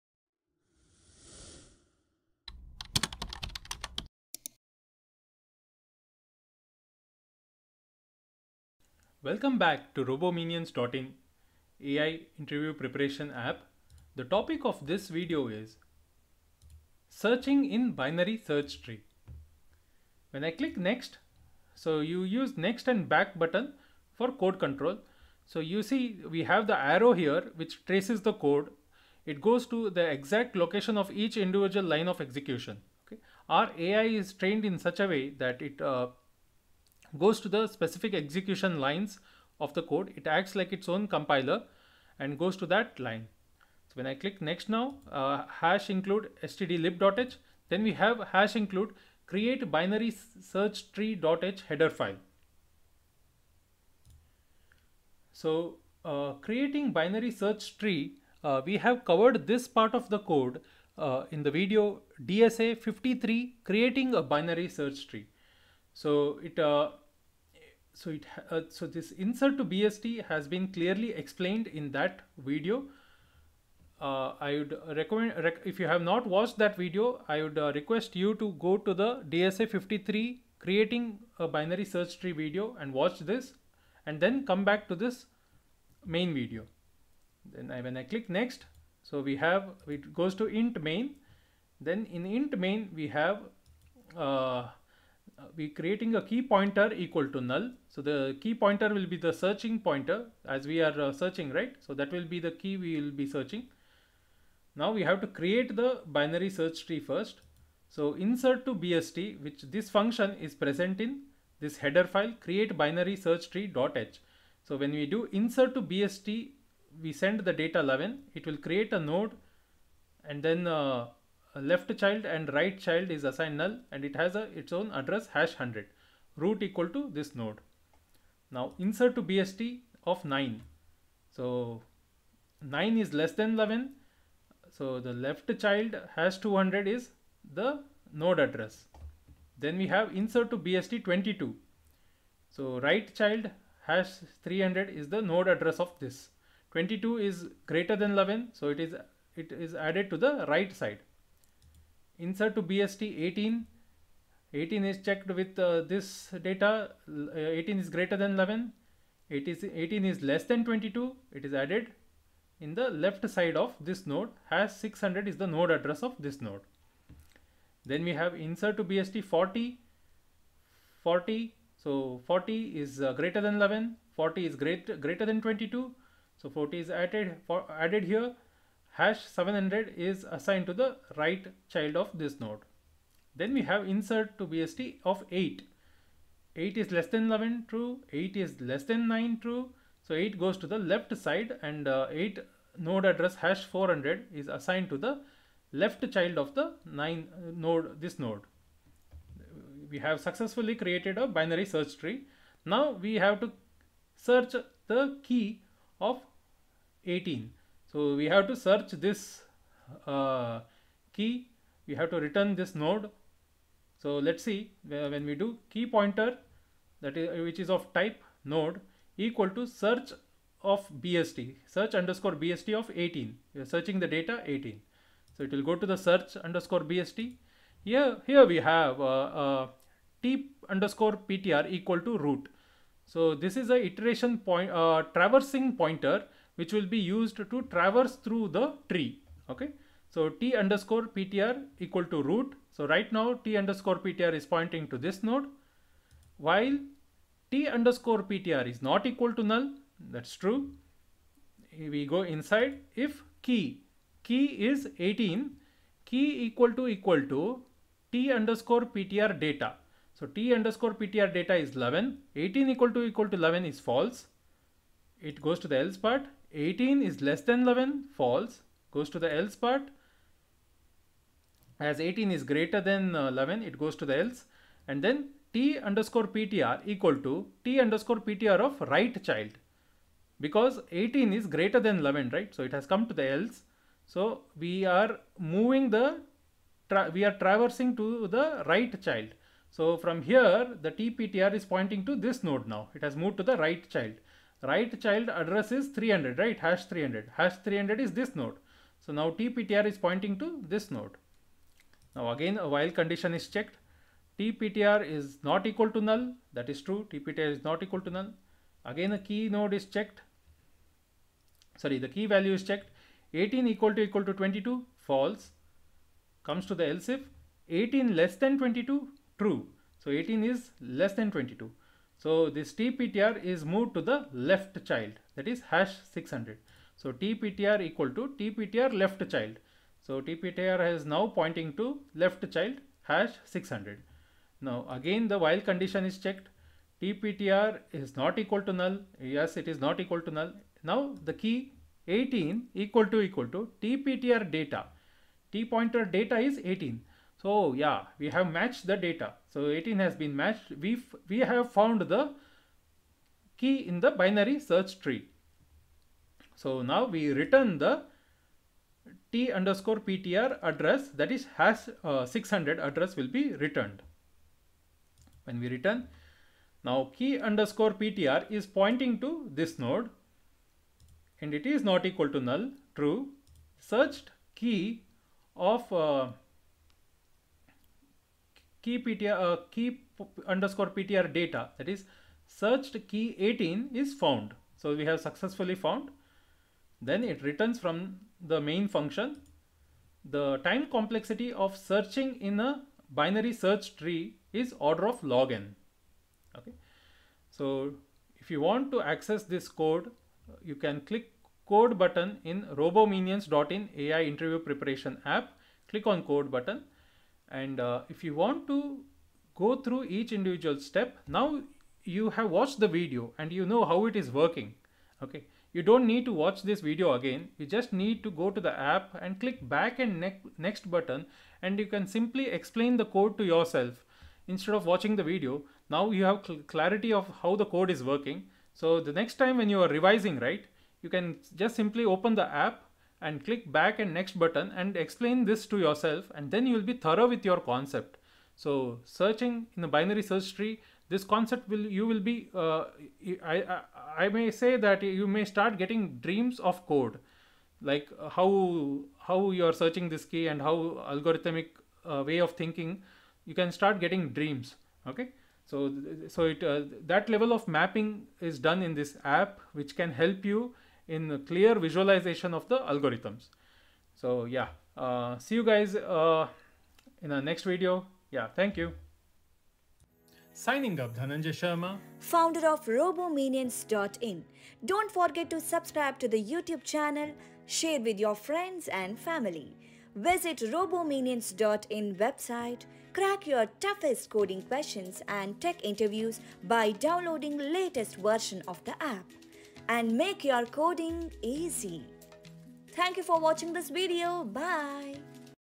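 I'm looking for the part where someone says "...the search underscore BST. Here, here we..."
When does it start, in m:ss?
3:45.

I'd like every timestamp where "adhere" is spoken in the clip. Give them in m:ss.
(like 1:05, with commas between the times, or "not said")
not said.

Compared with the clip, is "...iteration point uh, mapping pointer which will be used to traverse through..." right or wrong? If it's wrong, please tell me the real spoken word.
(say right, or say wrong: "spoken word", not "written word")
wrong: "traversing", not "mapping".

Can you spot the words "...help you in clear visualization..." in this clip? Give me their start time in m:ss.
7:40.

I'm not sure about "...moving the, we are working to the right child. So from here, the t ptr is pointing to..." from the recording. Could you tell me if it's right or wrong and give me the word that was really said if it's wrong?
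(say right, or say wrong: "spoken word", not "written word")
wrong: "traversing", not "working".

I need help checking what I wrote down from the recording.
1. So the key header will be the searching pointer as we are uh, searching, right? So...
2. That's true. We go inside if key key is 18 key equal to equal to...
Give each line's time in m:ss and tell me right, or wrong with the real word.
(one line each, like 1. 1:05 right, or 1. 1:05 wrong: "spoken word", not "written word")
1. 1:37 wrong: "pointer", not "header"
2. 4:09 right.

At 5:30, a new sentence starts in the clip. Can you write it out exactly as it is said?
So tptr is now pointing to left child hash 600.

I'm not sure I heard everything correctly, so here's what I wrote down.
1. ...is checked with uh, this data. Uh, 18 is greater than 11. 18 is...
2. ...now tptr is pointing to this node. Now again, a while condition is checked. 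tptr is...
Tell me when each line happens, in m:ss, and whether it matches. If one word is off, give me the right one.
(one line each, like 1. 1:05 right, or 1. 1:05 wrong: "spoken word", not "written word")
1. 2:34 right
2. 4:59 right.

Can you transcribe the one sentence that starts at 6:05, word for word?
When we return, now key underscore ptr is pointing to this node and it is not equal to null, true.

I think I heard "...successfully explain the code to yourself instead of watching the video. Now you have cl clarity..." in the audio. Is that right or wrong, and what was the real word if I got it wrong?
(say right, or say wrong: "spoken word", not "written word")
wrong: "simply", not "successfully".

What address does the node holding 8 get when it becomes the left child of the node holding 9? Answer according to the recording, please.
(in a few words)
#400.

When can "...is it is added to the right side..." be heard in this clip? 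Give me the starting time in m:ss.
2:28.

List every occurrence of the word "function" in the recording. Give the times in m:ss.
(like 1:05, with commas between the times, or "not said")
1:49, 6:28.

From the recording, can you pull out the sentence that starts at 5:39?
Yes, it is not equal to null.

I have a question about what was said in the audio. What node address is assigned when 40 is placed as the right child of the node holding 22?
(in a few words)
#700.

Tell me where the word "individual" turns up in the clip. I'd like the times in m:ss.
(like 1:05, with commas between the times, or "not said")
0:31, 6:50.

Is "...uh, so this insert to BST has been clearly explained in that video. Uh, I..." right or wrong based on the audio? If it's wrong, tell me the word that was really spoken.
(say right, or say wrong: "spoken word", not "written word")
right.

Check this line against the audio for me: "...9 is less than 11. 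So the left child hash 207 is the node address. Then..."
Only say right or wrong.
wrong.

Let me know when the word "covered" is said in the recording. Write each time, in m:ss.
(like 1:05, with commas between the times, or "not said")
0:59.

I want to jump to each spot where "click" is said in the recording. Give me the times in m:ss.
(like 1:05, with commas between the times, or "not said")
0:20, 0:44, 1:28, 6:41, 6:45, 6:59, 7:13.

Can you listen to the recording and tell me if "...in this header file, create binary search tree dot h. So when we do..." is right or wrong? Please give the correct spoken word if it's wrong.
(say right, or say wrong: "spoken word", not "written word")
right.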